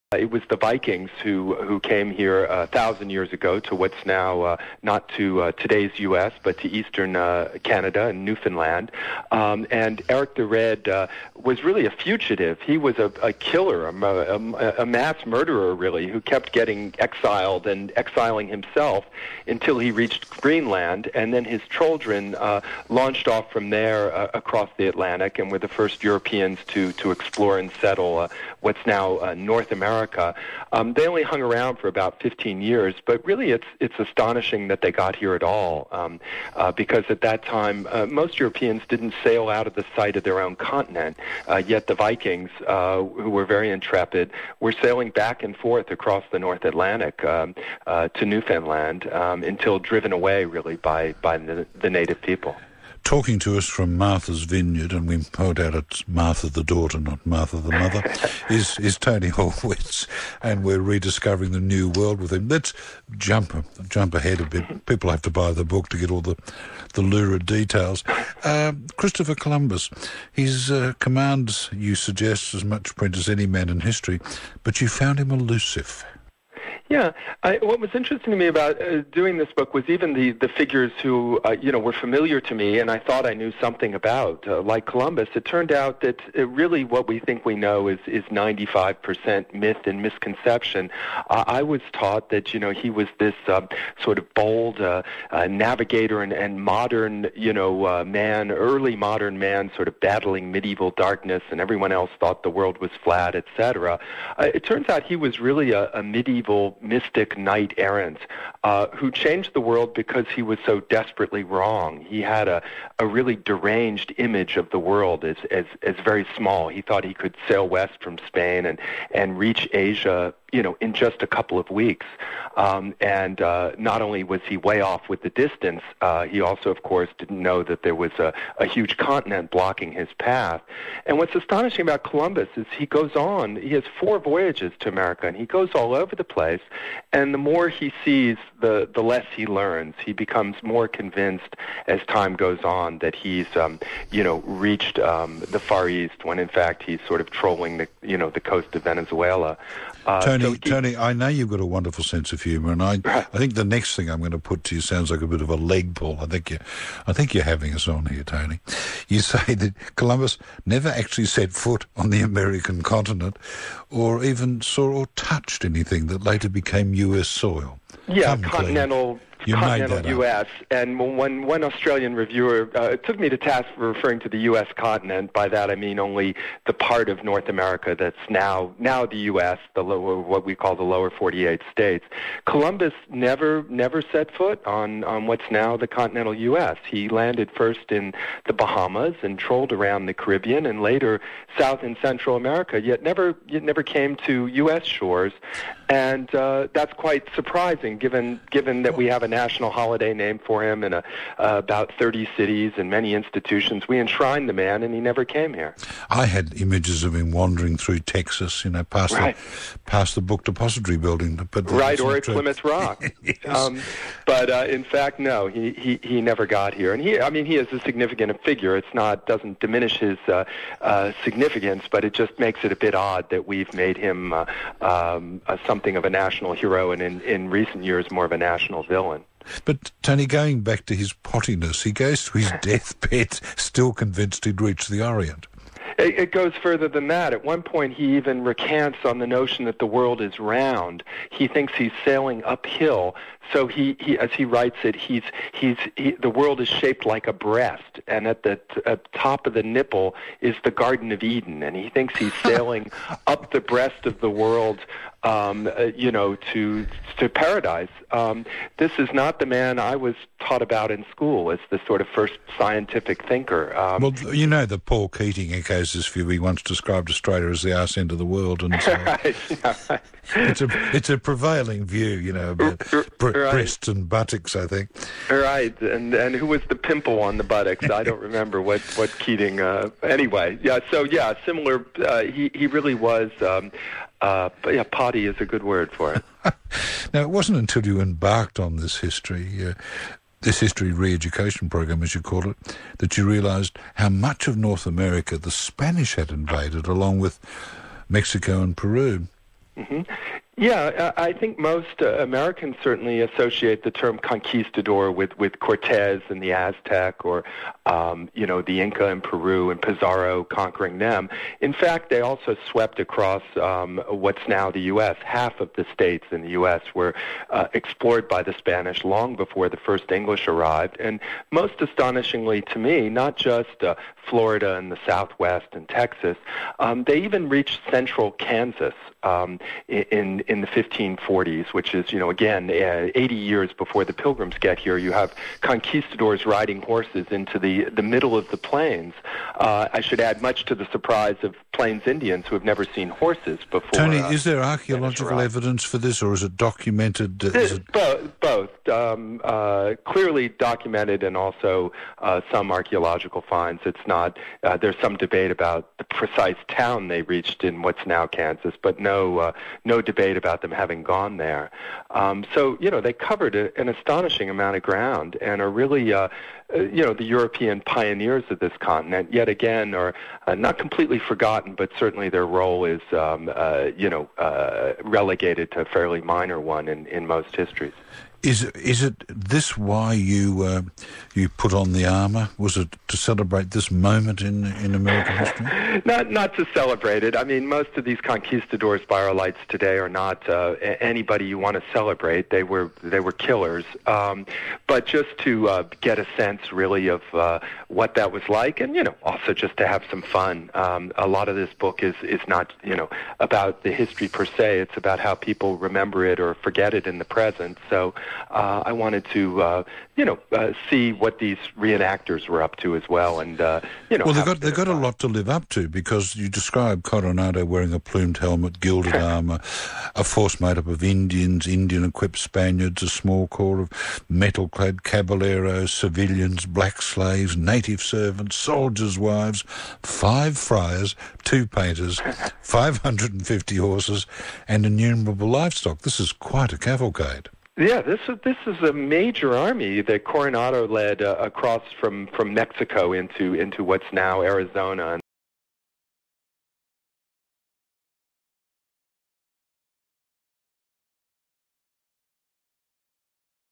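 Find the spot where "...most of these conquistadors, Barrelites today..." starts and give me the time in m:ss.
6:27.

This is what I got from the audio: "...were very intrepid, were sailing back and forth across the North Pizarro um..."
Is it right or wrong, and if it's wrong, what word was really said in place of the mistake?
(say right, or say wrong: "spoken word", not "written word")
wrong: "Atlantic", not "Pizarro".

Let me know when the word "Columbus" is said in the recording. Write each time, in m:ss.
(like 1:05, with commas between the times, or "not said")
1:09, 1:24, 2:12, 2:39, 3:02.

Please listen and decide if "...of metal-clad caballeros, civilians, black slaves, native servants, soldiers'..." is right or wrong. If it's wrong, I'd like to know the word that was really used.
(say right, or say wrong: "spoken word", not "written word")
right.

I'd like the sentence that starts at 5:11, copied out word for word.
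In fact, they also swept across um, what's now the U.S.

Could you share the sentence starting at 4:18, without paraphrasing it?
Um, this is not the man I was taught about in school as the sort of first scientific thinker.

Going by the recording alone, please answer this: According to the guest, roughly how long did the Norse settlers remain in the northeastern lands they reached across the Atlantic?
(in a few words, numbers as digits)
About 15 years.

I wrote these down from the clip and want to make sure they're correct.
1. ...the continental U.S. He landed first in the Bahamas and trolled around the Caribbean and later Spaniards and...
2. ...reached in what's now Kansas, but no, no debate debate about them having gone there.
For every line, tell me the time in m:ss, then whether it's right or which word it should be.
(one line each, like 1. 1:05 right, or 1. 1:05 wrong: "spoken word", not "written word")
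1. 3:05 wrong: "South", not "Spaniards"
2. 5:57 right.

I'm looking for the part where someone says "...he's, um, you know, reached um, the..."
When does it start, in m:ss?
2:23.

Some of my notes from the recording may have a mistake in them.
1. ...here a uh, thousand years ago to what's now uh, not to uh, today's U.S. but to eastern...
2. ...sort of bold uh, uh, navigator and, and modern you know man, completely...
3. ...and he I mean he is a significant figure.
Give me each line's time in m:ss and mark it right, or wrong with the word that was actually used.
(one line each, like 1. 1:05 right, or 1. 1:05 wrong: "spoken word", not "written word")
1. 0:02 right
2. 1:34 wrong: "early", not "completely"
3. 3:36 right.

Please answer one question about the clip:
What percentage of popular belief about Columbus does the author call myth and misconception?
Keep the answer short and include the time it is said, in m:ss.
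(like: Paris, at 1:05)
95%, at 1:28.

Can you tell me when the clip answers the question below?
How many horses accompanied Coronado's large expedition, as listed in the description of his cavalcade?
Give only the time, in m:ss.
7:12.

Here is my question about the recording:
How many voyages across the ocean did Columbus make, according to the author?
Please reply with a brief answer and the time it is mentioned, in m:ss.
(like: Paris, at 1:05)
4, at 2:13.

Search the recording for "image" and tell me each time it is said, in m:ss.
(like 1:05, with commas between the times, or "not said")
1:54, 3:26.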